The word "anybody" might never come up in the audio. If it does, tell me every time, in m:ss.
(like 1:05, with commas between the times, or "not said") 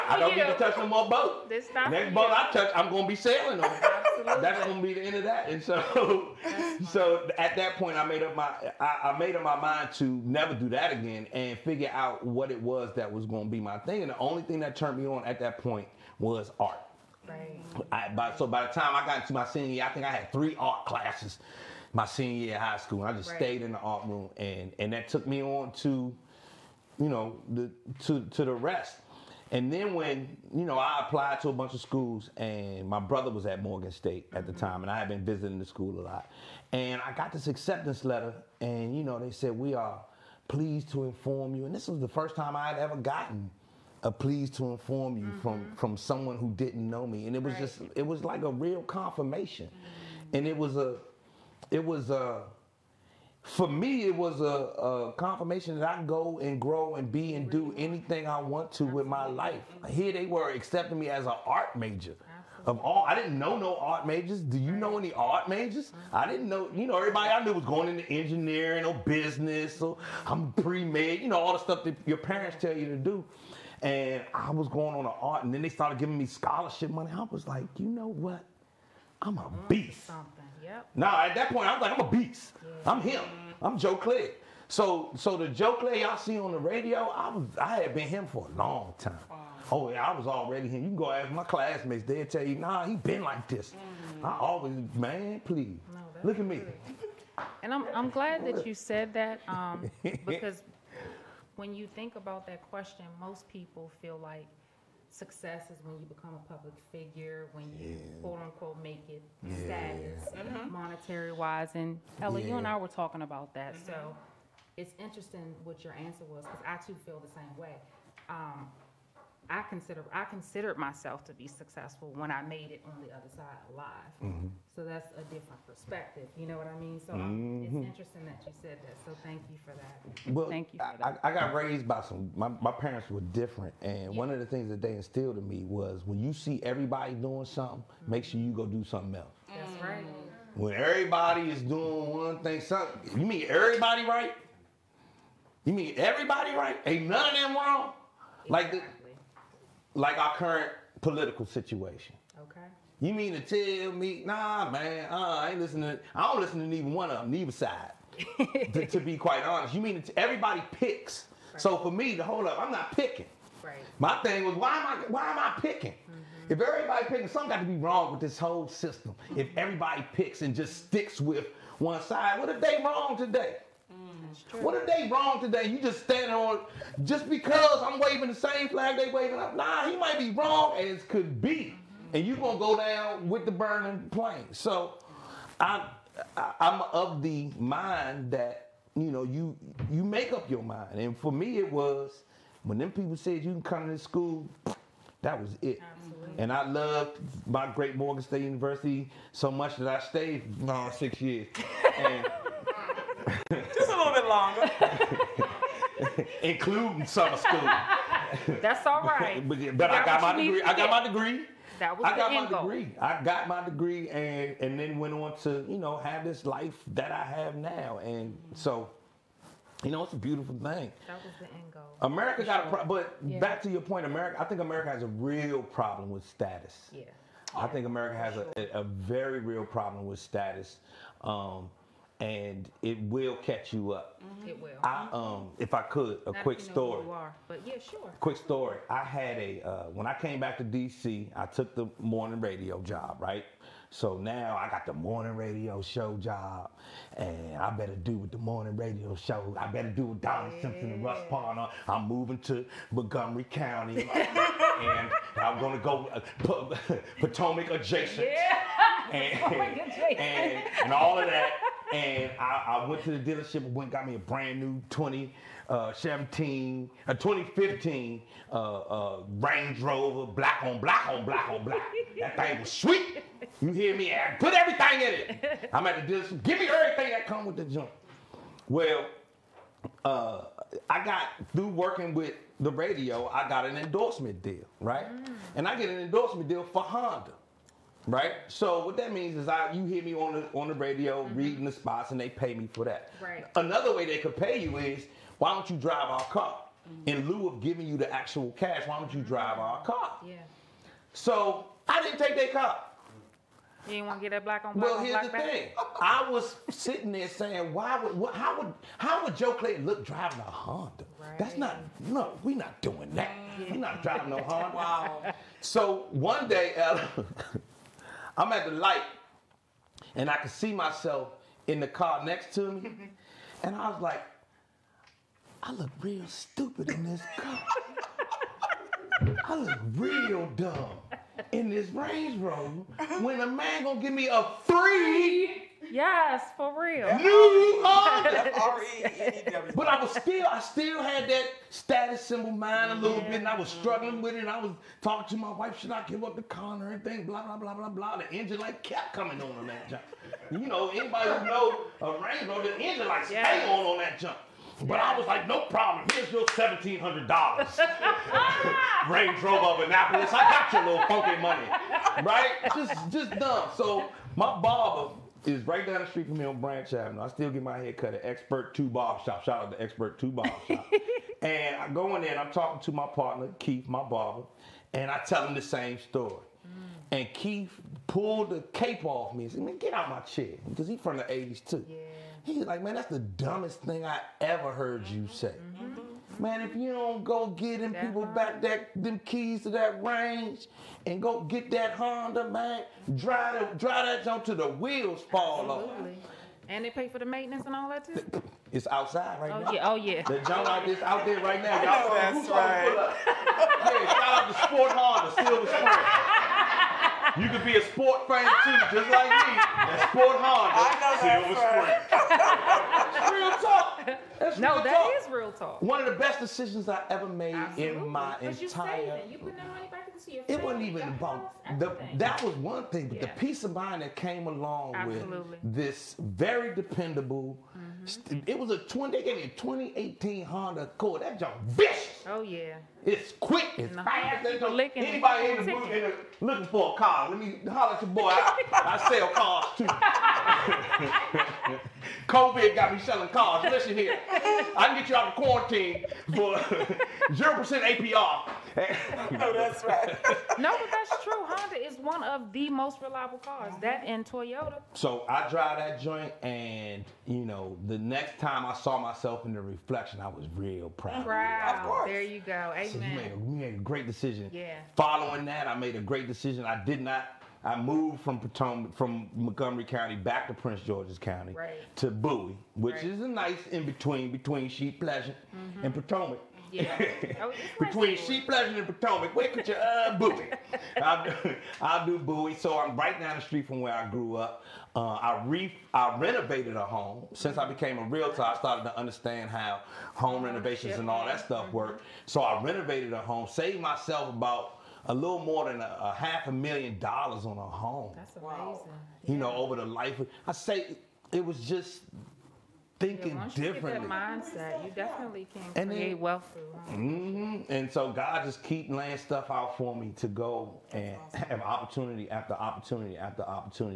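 5:50, 7:15.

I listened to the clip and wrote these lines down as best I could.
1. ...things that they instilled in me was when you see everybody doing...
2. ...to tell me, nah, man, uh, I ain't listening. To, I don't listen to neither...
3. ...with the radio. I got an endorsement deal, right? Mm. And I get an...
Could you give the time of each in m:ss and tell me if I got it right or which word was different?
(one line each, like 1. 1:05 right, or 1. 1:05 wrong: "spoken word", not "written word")
1. 2:14 right
2. 2:33 right
3. 4:42 right.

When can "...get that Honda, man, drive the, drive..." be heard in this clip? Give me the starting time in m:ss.
6:31.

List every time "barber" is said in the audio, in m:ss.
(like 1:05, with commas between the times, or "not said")
6:04, 6:14.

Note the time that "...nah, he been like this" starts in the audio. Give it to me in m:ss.
1:32.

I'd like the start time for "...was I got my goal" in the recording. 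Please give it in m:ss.
3:31.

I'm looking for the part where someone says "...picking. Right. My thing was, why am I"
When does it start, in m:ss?
2:42.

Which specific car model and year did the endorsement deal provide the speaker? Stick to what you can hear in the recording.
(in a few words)
2018 Honda Accord.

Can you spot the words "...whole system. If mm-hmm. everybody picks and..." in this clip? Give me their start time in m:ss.
2:48.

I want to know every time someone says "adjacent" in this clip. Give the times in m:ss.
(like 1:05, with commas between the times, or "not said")
4:17.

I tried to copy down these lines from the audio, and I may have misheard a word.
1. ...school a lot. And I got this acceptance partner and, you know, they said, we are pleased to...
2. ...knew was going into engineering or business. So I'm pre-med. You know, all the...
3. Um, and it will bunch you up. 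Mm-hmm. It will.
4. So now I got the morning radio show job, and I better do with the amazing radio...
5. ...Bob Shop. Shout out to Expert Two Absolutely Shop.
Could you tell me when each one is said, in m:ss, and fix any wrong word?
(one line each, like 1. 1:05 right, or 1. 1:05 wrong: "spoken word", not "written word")
1. 0:35 wrong: "letter", not "partner"
2. 1:07 right
3. 3:51 wrong: "catch", not "bunch"
4. 4:03 wrong: "morning", not "amazing"
5. 6:08 wrong: "Bob", not "Absolutely".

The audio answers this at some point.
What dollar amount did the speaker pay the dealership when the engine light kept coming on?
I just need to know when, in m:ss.
5:56.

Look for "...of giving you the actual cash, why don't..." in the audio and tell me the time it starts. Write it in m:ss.
4:57.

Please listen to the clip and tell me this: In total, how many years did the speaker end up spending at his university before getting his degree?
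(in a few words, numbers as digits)
6.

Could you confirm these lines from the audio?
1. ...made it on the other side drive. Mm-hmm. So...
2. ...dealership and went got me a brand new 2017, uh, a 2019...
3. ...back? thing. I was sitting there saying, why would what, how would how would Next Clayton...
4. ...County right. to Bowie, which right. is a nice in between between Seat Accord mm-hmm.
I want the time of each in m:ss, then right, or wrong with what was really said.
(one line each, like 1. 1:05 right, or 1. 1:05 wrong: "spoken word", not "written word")
1. 2:02 wrong: "alive", not "drive"
2. 4:23 wrong: "2015", not "2019"
3. 5:05 wrong: "Joe", not "Next"
4. 7:51 wrong: "Pleasant", not "Accord".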